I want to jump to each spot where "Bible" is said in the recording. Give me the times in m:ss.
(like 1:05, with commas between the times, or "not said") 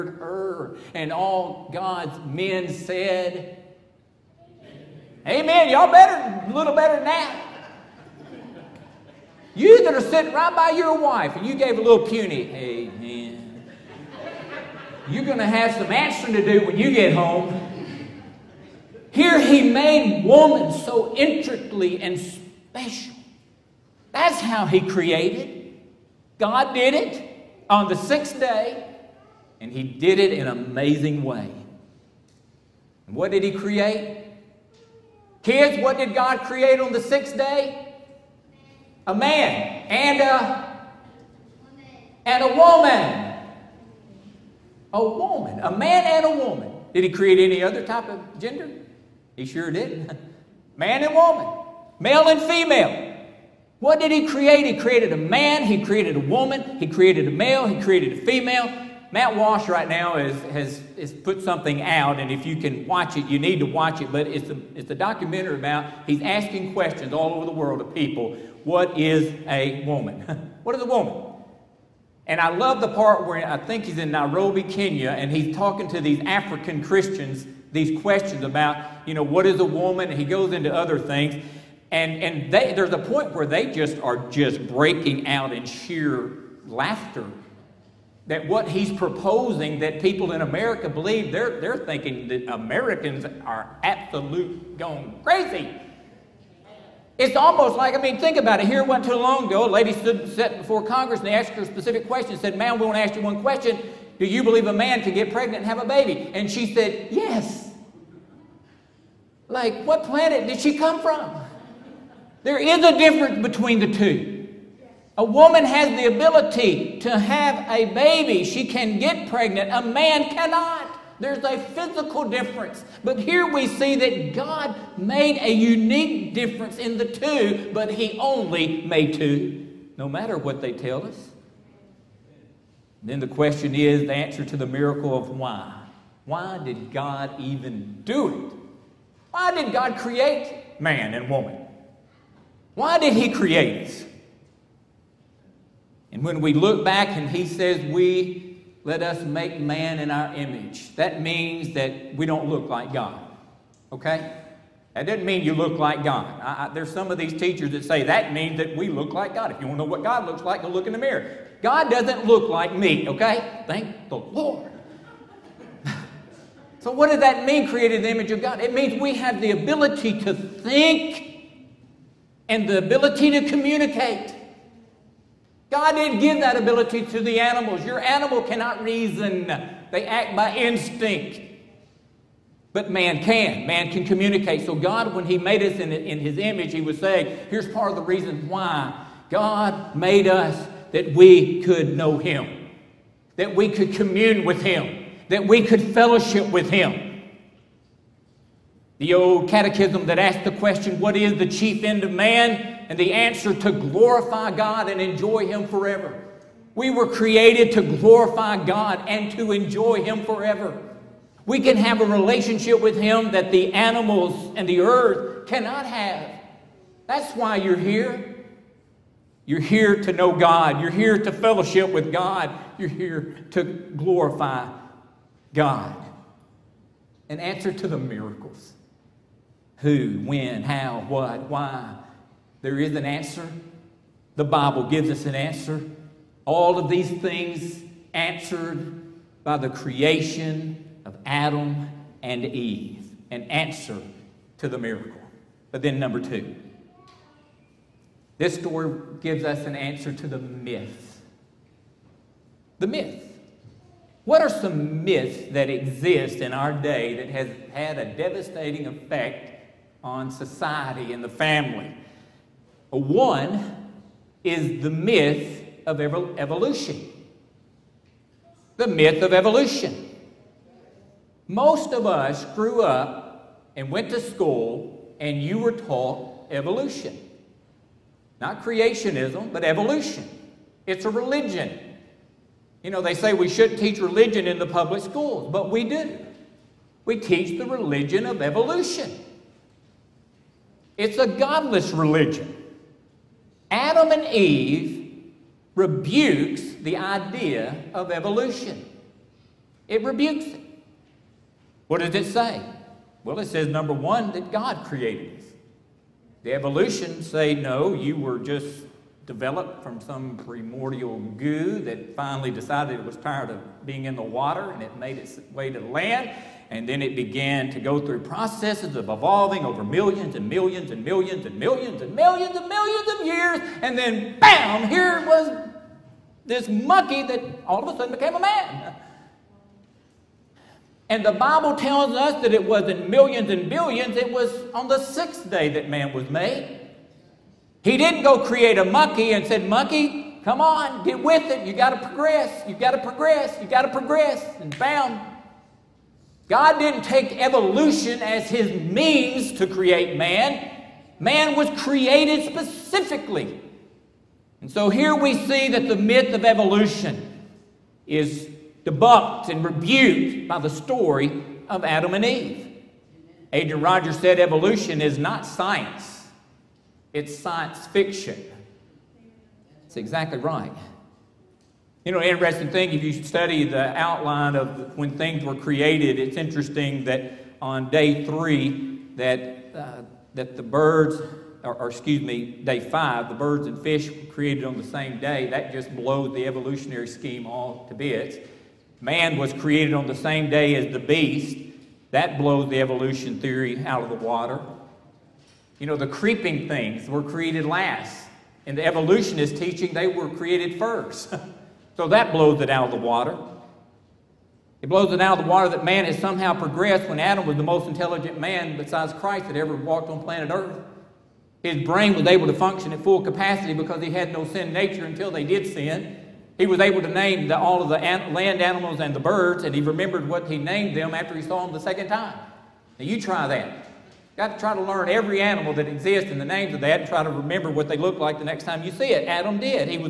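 3:54, 5:31.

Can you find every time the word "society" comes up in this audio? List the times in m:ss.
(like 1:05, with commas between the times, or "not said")
4:20.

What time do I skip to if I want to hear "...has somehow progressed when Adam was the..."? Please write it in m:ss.
6:46.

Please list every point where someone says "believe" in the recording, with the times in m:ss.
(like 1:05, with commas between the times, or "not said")
1:30, 1:44.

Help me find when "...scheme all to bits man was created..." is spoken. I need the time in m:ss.
6:27.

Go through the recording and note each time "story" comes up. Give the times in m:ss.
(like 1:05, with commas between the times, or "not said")
4:08, 6:00.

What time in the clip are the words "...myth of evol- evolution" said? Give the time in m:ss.
4:24.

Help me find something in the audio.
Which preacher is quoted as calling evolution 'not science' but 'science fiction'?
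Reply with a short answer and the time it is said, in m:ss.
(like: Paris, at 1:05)
Adrian Rogers, at 6:03.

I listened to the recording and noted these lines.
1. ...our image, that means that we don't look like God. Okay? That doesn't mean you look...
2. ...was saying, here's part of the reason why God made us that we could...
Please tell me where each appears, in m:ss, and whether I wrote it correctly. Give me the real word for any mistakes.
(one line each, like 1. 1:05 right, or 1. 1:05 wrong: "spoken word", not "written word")
1. 2:30 right
2. 3:06 right.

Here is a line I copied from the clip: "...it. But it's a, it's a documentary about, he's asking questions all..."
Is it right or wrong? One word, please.
right.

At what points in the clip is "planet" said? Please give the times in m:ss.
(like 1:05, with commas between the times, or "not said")
1:50, 6:50.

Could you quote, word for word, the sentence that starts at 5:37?
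He didn't go create a monkey and said, Monkey, come on, get with it.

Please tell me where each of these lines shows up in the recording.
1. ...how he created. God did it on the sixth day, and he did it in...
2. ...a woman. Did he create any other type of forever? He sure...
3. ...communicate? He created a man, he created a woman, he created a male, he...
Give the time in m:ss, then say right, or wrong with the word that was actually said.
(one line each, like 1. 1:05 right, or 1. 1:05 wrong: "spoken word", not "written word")
1. 0:24 right
2. 0:46 wrong: "gender", not "forever"
3. 0:54 wrong: "create", not "communicate".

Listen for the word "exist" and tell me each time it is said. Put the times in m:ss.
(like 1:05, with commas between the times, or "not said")
4:15, 7:05.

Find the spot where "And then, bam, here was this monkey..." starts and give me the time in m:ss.
5:23.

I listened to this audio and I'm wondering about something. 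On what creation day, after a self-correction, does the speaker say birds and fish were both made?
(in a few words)
day five.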